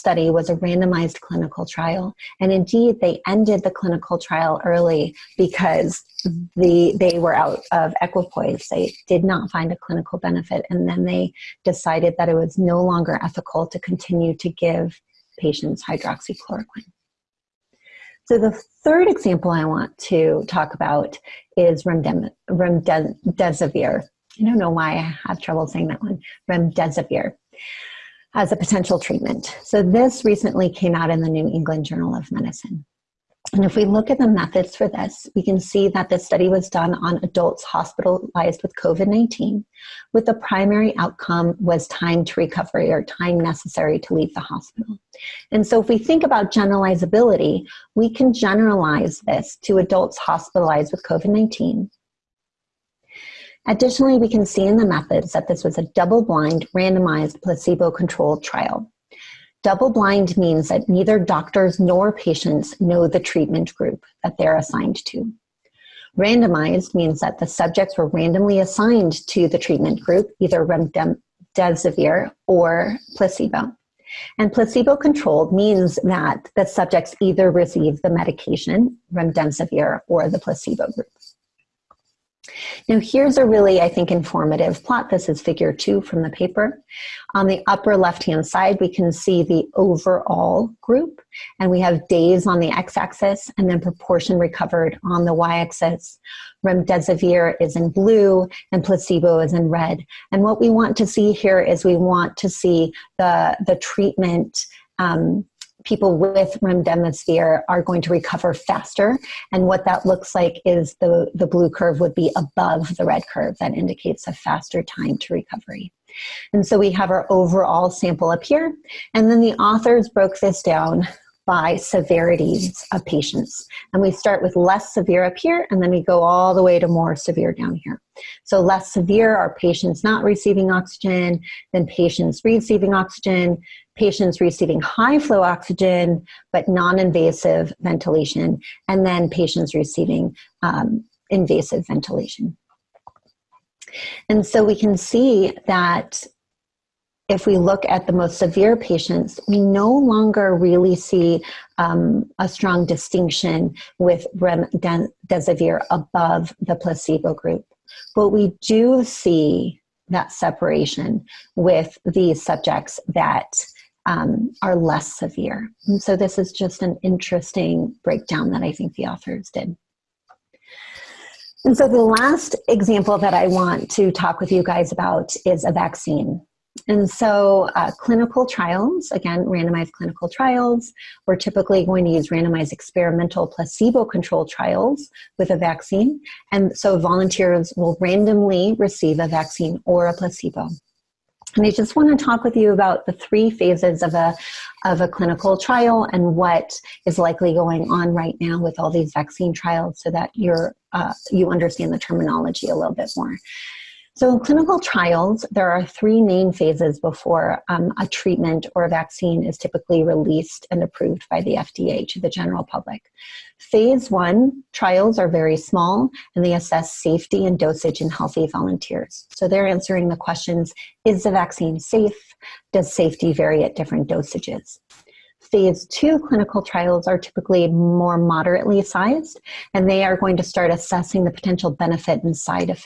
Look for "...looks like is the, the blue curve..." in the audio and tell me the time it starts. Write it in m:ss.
1:50.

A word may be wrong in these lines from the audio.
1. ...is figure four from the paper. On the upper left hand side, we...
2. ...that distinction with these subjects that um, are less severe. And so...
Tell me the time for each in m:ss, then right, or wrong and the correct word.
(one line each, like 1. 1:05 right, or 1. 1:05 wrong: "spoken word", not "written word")
1. 1:25 wrong: "two", not "four"
2. 2:40 wrong: "separation", not "distinction".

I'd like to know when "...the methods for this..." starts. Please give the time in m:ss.
0:34.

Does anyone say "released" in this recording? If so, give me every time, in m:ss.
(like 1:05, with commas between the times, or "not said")
3:30.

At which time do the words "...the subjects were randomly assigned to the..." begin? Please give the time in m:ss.
1:07.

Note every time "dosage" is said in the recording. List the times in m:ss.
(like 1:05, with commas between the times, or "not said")
3:37, 3:44.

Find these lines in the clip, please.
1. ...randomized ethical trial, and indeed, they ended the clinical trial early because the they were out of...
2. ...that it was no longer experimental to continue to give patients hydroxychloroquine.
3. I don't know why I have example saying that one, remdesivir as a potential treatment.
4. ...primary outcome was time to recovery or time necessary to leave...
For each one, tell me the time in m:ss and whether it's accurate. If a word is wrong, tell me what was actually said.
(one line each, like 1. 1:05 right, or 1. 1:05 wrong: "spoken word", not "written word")
1. 0:00 wrong: "clinical", not "ethical"
2. 0:12 wrong: "ethical", not "experimental"
3. 0:24 wrong: "trouble", not "example"
4. 0:40 right.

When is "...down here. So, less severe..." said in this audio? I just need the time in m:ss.
2:07.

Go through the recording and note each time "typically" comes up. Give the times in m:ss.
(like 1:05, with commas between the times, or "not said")
3:01, 3:29, 3:47.